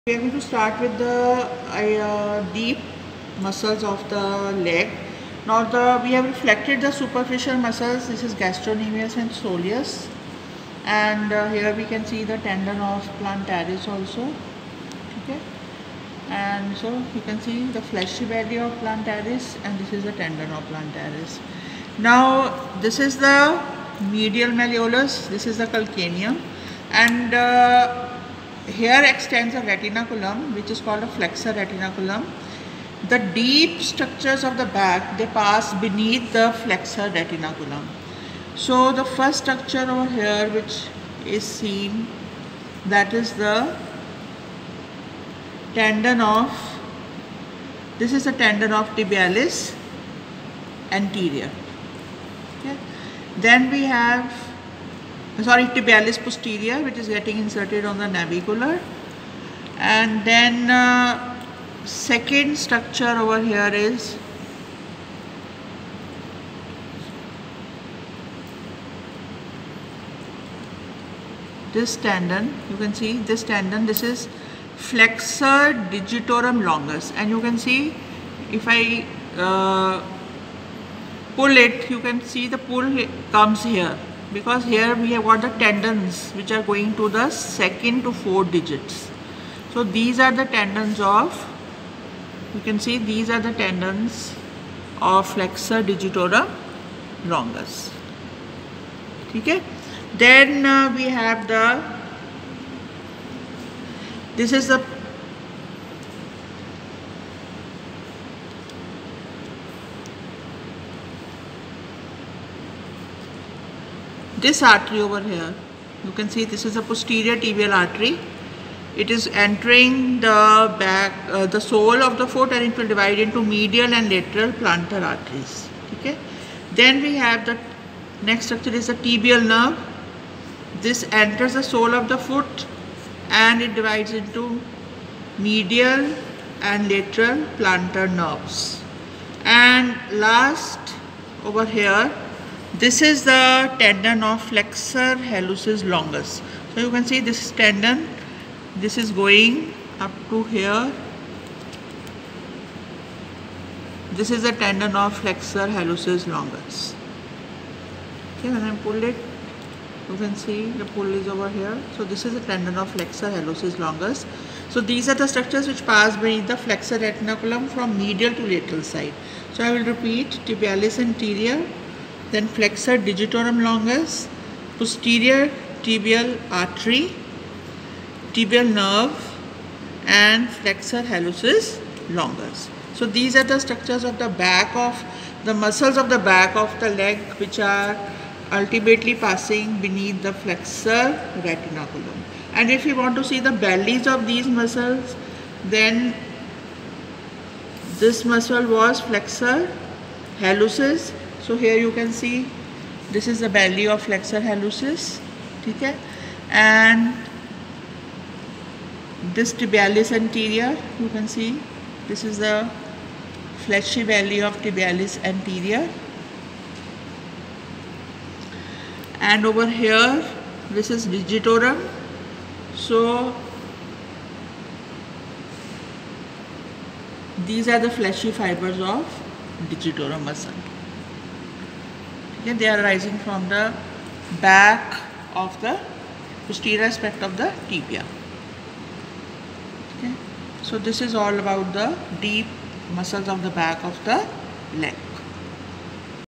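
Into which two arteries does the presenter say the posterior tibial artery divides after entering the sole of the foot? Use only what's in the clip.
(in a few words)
medial and lateral plantar arteries.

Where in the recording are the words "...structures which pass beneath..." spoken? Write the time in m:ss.
2:45.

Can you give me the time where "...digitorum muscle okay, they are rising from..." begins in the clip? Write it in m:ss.
3:49.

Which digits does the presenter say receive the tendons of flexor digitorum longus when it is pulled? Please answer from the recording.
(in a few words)
second to four digits.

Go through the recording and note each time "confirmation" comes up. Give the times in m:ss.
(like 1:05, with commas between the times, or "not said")
not said.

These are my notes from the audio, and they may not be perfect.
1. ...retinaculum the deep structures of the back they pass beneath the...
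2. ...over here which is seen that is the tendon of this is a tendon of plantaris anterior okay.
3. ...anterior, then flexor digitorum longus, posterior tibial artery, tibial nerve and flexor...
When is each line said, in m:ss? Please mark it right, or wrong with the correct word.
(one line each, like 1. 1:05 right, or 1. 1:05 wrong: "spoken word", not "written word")
1. 0:31 right
2. 0:39 wrong: "tibialis", not "plantaris"
3. 2:50 right.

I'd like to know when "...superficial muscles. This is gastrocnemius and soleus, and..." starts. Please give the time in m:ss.
0:06.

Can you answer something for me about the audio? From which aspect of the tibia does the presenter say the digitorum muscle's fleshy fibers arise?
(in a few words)
posterior aspect.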